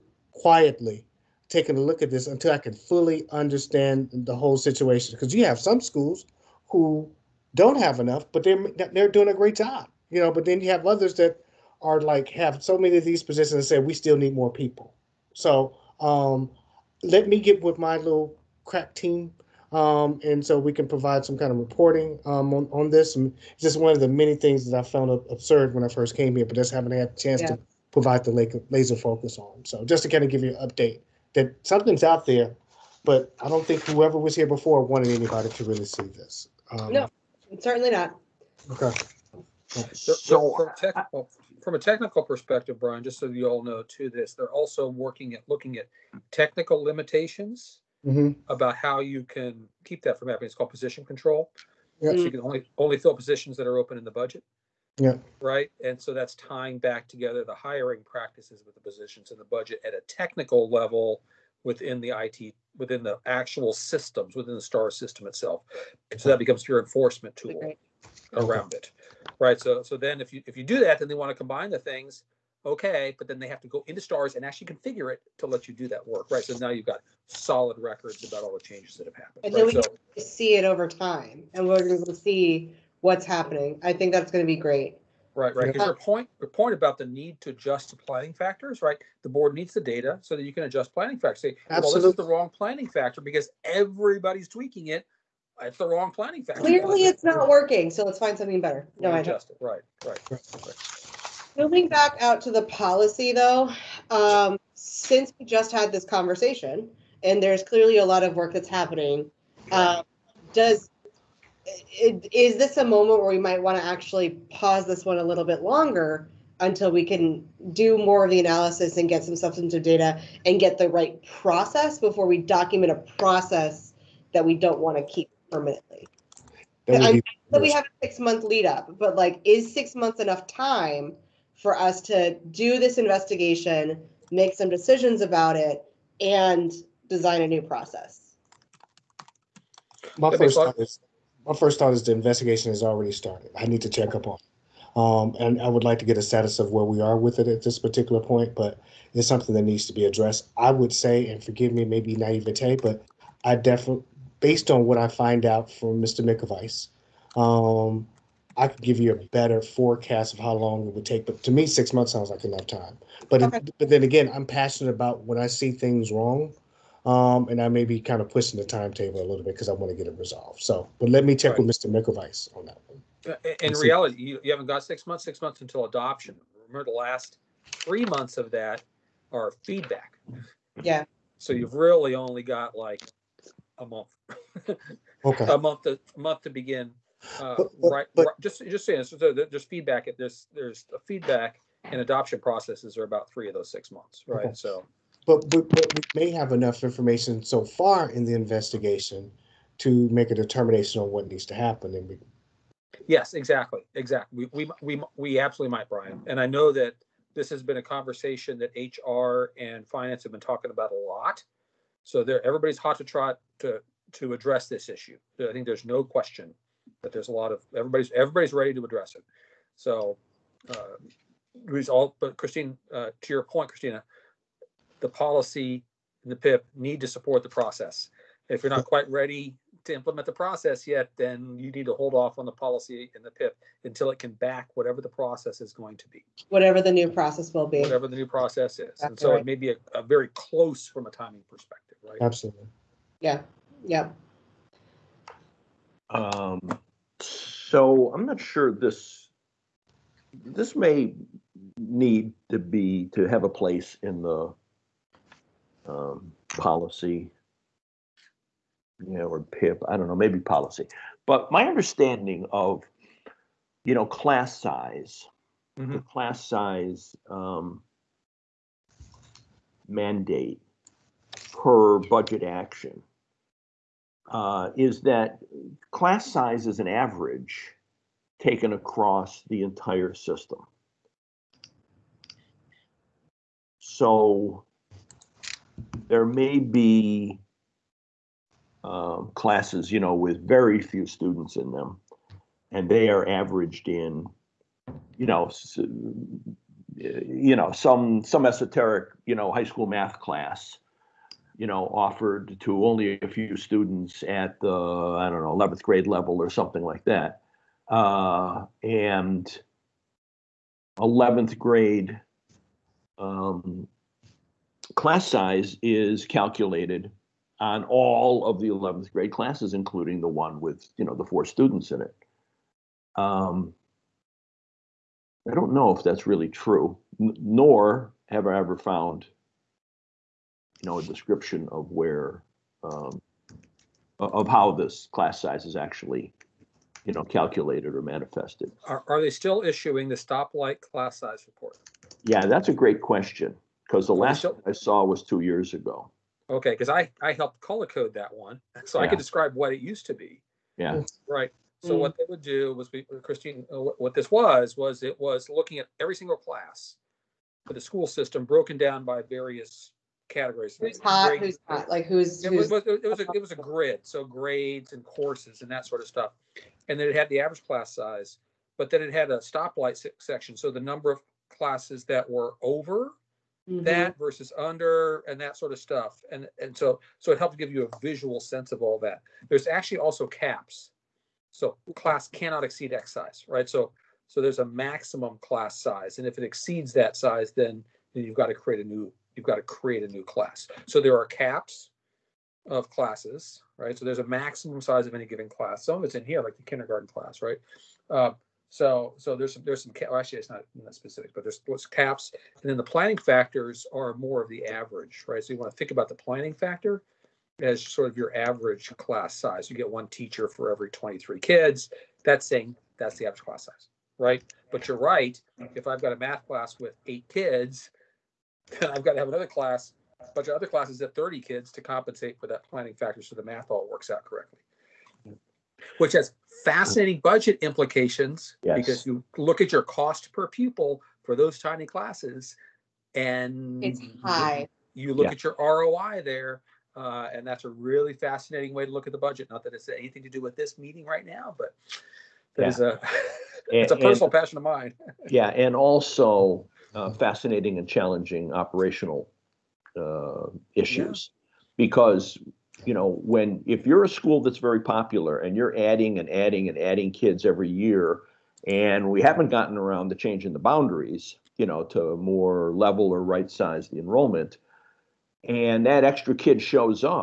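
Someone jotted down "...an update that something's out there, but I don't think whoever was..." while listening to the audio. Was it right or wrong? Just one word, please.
right.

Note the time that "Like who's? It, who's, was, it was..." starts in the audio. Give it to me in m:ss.
6:01.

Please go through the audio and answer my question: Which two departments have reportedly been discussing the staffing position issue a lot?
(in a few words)
HR and finance.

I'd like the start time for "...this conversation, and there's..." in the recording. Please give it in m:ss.
1:45.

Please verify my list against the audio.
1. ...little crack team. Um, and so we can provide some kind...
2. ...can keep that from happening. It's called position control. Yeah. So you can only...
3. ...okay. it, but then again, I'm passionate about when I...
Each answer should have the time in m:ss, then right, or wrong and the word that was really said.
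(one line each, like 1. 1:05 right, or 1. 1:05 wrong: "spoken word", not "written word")
1. 0:17 right
2. 0:49 right
3. 2:43 right.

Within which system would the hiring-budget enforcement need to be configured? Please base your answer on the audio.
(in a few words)
star system.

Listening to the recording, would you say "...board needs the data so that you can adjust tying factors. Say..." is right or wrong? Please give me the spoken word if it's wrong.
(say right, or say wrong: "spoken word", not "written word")
wrong: "planning", not "tying".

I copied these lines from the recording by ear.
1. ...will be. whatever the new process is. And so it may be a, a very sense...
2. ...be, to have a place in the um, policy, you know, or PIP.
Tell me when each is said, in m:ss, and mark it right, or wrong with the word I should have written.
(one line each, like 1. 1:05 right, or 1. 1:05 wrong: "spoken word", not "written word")
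1. 3:57 wrong: "close", not "sense"
2. 4:12 right.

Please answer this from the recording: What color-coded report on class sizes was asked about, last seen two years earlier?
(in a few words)
stoplight class size report.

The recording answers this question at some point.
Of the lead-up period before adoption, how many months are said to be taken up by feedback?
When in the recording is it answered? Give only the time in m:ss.
2:56.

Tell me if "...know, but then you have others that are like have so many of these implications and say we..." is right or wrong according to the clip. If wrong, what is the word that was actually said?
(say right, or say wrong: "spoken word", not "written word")
wrong: "positions", not "implications".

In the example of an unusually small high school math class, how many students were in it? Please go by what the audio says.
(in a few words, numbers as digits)
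4.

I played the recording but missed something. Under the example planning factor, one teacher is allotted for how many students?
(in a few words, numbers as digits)
23.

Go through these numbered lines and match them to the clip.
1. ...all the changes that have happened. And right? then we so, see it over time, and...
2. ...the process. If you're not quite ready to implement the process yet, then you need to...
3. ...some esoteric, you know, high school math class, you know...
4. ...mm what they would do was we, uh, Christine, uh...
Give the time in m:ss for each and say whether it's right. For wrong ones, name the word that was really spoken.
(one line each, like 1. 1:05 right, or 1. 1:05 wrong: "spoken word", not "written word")
1. 1:18 right
2. 3:47 right
3. 4:58 right
4. 5:51 right.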